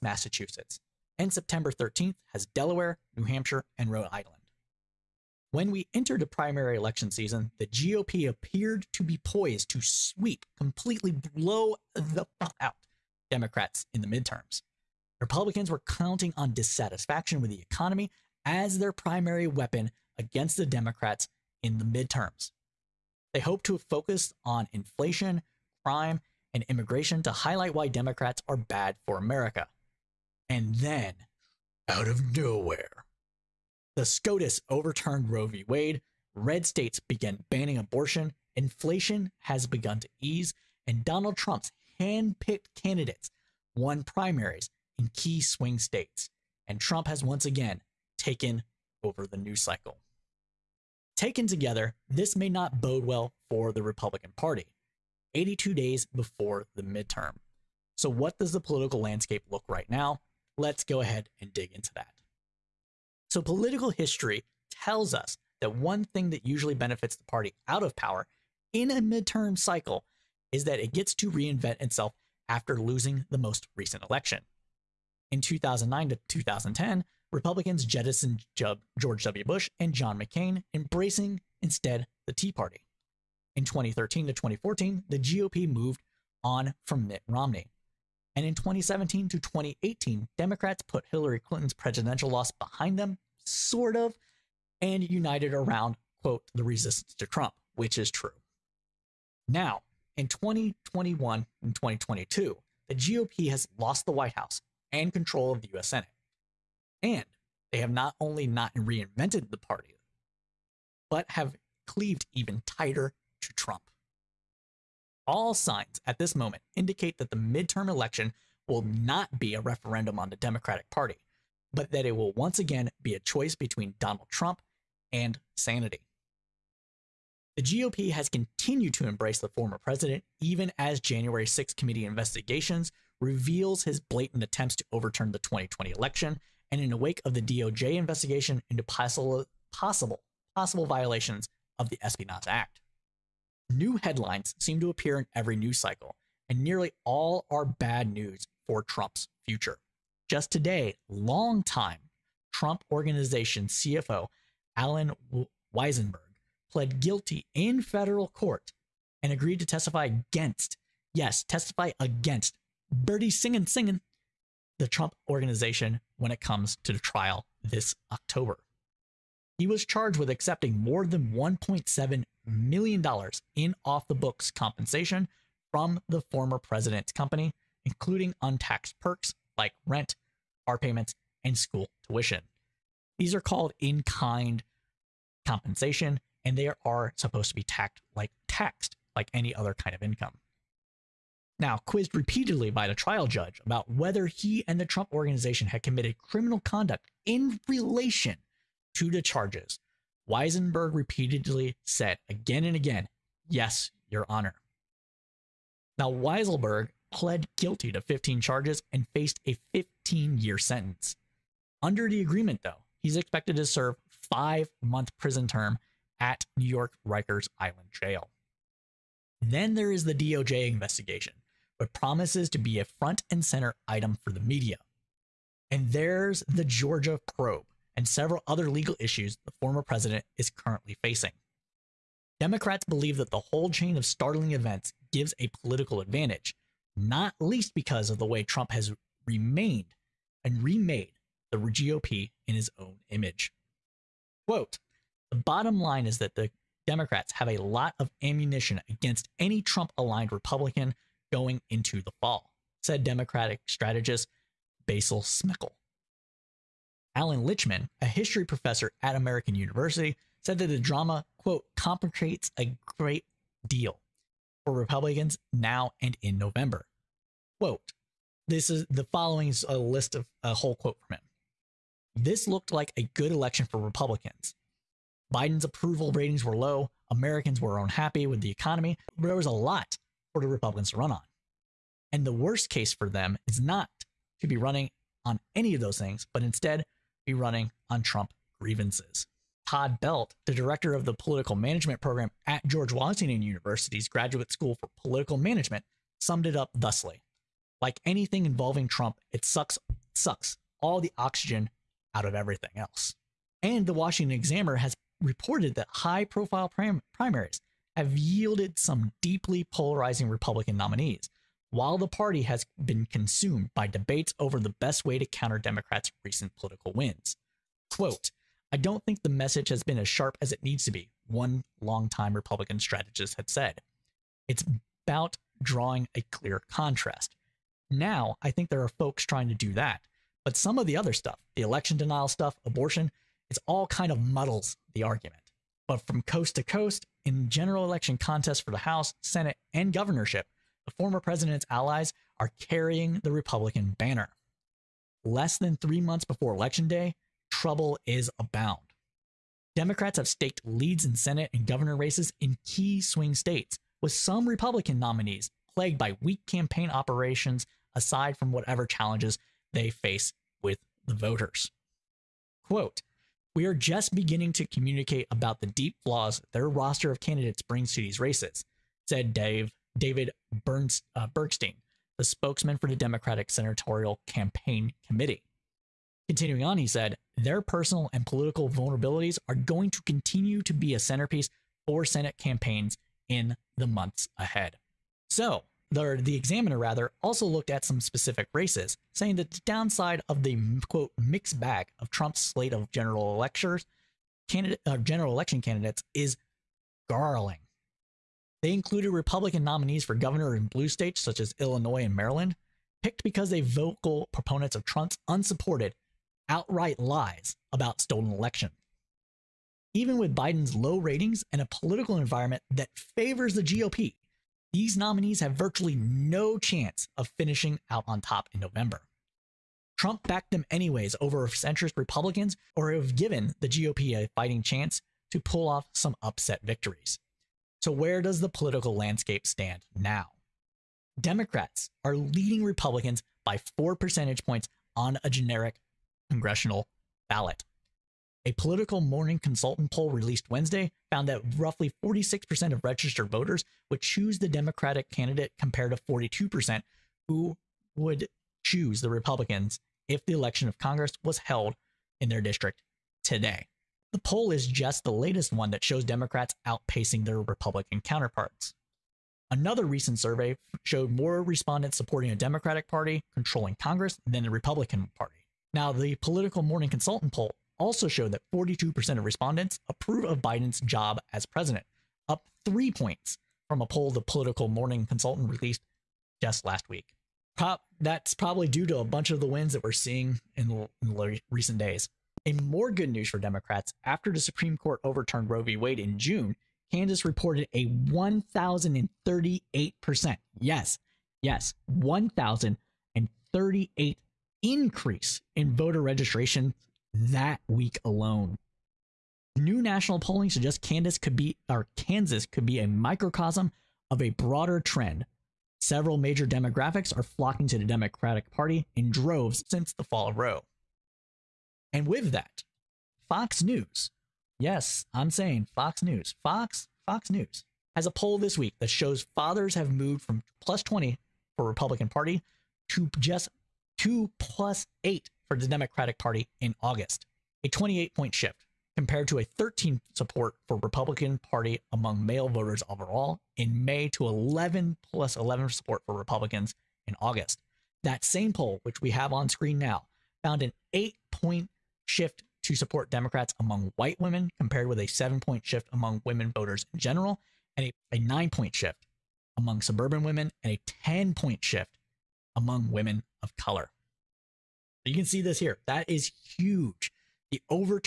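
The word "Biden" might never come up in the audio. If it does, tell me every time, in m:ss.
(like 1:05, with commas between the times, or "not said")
4:35, 6:50, 7:50.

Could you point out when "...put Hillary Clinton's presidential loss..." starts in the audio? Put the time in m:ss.
1:30.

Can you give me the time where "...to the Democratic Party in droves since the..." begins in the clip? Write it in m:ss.
8:27.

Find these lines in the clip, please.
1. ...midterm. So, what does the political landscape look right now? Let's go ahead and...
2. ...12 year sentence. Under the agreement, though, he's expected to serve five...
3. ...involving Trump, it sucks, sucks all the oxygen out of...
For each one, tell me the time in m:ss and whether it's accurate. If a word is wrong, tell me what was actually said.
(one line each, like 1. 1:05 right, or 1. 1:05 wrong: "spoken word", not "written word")
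1. 0:56 right
2. 3:29 wrong: "15", not "12"
3. 4:58 right.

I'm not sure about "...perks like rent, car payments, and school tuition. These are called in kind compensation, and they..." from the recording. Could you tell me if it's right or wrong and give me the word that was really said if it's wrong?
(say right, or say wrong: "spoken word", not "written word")
right.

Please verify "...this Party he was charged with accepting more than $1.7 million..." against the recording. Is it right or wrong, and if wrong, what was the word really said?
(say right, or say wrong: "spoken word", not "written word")
wrong: "October", not "Party".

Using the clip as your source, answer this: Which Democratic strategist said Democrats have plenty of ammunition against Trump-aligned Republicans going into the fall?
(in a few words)
Basil Smikle.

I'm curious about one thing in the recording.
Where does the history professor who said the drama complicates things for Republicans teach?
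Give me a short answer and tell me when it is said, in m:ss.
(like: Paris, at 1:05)
American University, at 4:19.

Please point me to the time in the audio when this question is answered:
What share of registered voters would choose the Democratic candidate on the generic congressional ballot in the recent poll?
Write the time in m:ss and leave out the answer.
7:22.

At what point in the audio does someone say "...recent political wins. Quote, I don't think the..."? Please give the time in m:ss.
5:16.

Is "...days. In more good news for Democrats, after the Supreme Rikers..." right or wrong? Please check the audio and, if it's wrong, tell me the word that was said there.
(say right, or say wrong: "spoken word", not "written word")
wrong: "Court", not "Rikers".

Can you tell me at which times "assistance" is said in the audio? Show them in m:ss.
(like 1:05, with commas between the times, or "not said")
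not said.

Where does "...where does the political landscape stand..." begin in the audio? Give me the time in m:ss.
7:07.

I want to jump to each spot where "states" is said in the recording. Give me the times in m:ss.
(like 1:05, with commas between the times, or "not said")
0:36, 0:45, 5:53, 6:40.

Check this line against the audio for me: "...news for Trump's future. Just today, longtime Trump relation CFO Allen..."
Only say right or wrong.
wrong.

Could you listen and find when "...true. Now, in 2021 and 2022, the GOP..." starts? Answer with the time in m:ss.
1:38.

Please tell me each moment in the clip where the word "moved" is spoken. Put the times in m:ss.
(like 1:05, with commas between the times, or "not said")
1:25, 8:39.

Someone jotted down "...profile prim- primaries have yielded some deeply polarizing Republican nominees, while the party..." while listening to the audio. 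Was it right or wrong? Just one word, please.
right.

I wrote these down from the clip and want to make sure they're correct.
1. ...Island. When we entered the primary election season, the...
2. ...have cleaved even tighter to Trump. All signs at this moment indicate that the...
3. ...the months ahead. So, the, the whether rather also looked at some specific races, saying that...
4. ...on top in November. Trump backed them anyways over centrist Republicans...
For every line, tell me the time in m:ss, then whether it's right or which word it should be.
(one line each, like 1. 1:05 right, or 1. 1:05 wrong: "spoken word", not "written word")
1. 0:04 right
2. 1:51 right
3. 6:23 wrong: "examiner", not "whether"
4. 6:58 right.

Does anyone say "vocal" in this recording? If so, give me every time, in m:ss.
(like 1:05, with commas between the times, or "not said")
6:43.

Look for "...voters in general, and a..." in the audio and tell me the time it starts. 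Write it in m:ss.
9:06.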